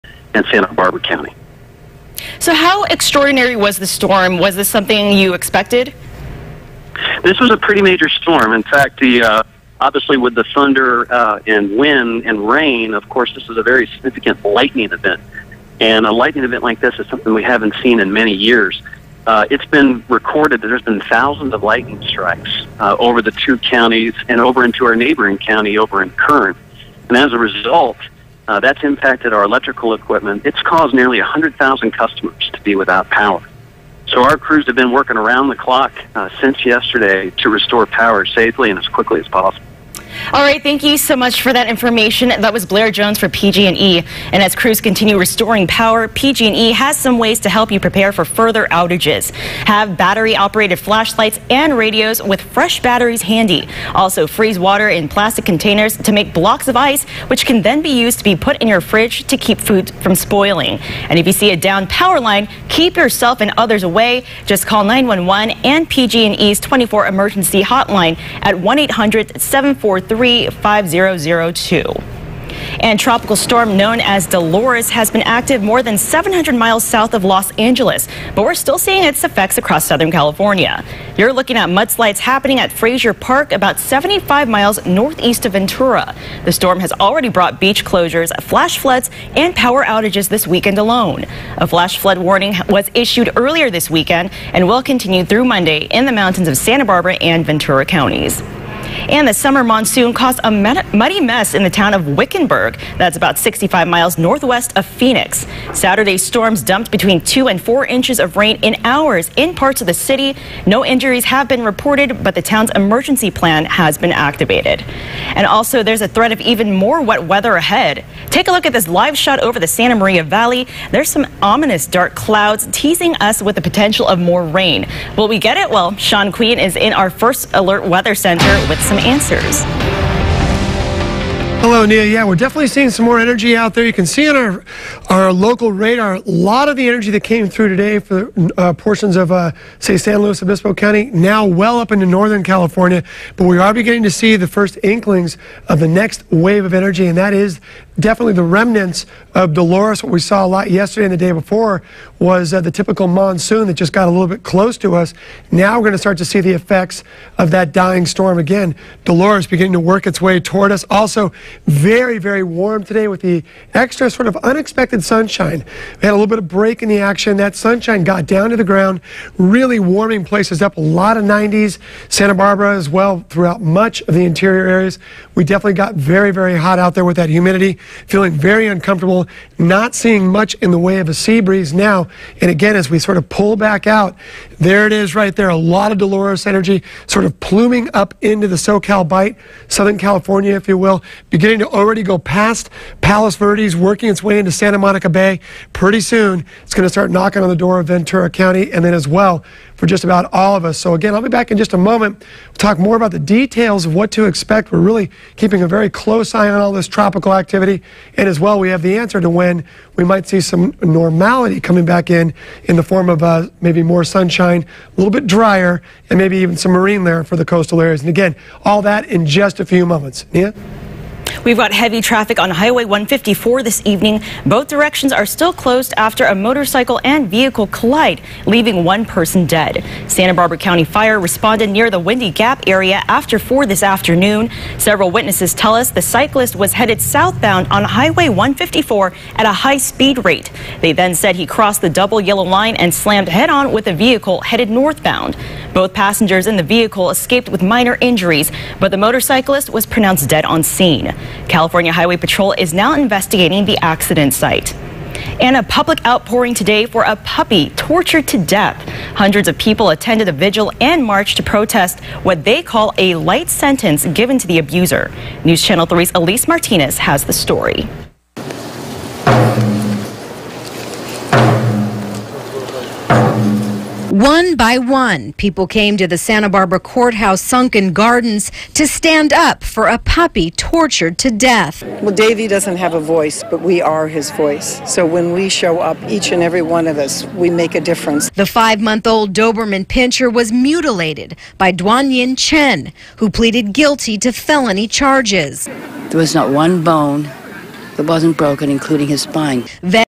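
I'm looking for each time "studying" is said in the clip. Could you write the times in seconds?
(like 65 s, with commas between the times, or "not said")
not said.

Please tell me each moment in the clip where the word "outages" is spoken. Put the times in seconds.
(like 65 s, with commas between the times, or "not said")
48 s, 89 s.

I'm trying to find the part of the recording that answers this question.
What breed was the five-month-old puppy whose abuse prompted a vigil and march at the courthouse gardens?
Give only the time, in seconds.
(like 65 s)
289 s.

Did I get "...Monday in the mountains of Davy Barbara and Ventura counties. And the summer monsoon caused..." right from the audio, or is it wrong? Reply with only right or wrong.
wrong.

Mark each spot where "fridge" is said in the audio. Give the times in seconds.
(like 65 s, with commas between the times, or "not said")
58 s.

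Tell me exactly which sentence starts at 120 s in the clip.
There's some ominous dark clouds teasing us with the potential of more rain.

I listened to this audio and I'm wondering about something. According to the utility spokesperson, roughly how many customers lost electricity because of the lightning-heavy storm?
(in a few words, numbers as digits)
100,000.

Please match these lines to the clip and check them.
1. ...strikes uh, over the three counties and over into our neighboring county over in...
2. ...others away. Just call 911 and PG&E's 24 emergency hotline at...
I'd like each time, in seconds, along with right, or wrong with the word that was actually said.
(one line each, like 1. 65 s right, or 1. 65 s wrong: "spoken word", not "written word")
1. 22 s wrong: "two", not "three"
2. 63 s right.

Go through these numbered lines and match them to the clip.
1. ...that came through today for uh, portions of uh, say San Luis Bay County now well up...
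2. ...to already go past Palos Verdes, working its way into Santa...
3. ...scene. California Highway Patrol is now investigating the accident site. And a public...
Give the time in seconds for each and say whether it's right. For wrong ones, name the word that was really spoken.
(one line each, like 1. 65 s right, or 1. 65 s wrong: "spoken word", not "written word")
1. 137 s wrong: "Obispo", not "Bay"
2. 191 s right
3. 250 s right.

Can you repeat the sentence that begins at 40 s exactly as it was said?
All right, thank you so much for that information.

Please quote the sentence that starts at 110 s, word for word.
No injuries have been reported, but the town's emergency plan has been activated.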